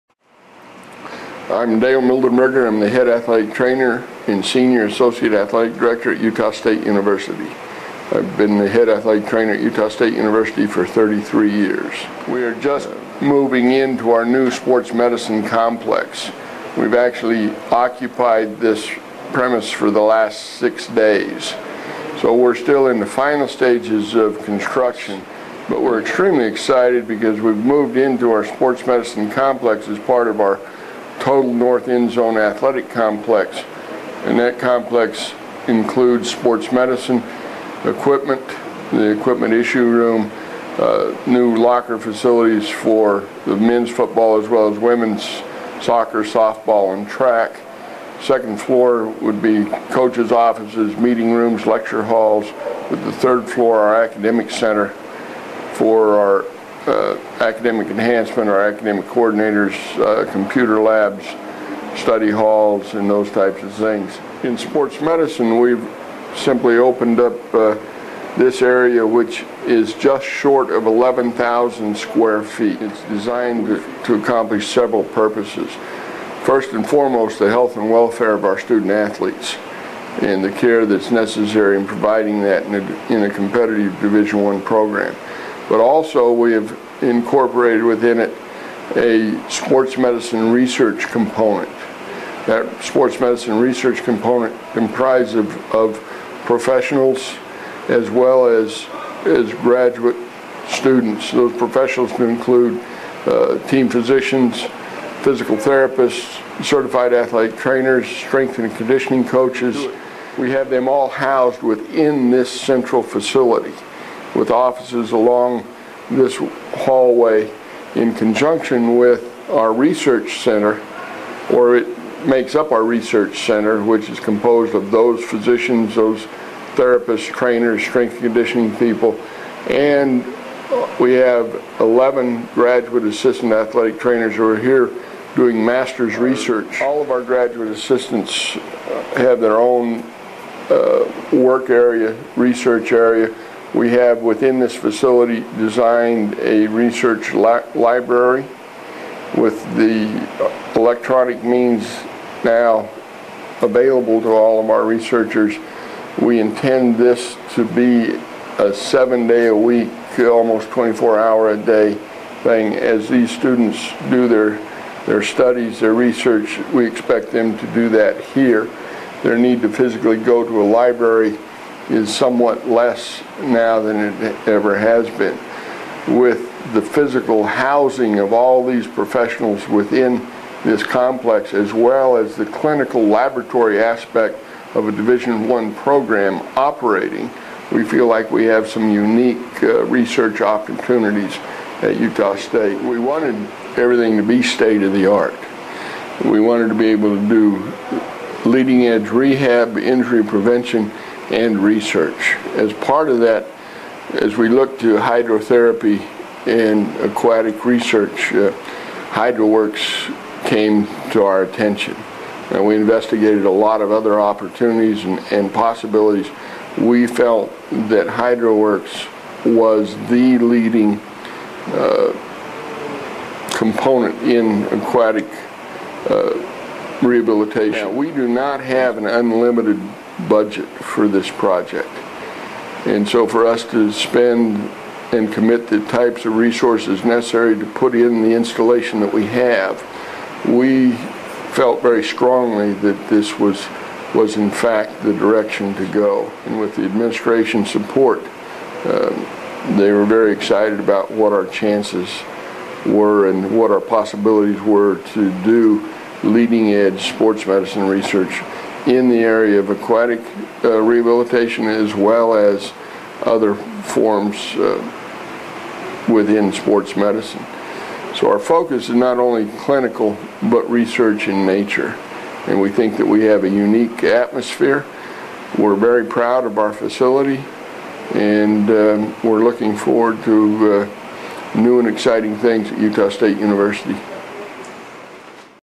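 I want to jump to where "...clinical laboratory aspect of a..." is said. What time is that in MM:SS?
03:02.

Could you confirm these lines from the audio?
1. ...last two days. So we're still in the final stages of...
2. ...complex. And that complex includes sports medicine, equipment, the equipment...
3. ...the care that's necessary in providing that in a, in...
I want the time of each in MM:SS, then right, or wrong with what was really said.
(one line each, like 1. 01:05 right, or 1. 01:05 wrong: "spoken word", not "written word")
1. 00:20 wrong: "six", not "two"
2. 00:32 right
3. 01:20 right.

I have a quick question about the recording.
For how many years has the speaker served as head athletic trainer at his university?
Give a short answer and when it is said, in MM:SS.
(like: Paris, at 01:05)
33, at 00:10.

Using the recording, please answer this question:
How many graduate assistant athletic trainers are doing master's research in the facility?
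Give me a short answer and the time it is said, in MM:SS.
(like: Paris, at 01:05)
11, at 02:11.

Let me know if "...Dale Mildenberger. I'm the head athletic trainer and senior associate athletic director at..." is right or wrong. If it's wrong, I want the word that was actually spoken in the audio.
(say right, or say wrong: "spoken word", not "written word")
right.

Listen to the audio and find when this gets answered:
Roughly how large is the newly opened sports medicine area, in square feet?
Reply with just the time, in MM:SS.
01:09.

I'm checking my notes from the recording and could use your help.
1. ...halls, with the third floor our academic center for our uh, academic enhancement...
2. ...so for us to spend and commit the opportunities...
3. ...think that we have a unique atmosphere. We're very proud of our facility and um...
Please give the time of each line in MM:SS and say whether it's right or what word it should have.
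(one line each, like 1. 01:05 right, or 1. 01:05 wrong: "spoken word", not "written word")
1. 00:52 right
2. 03:53 wrong: "types", not "opportunities"
3. 04:32 right.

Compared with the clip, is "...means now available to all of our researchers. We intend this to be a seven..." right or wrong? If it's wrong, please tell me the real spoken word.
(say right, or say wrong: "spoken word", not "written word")
right.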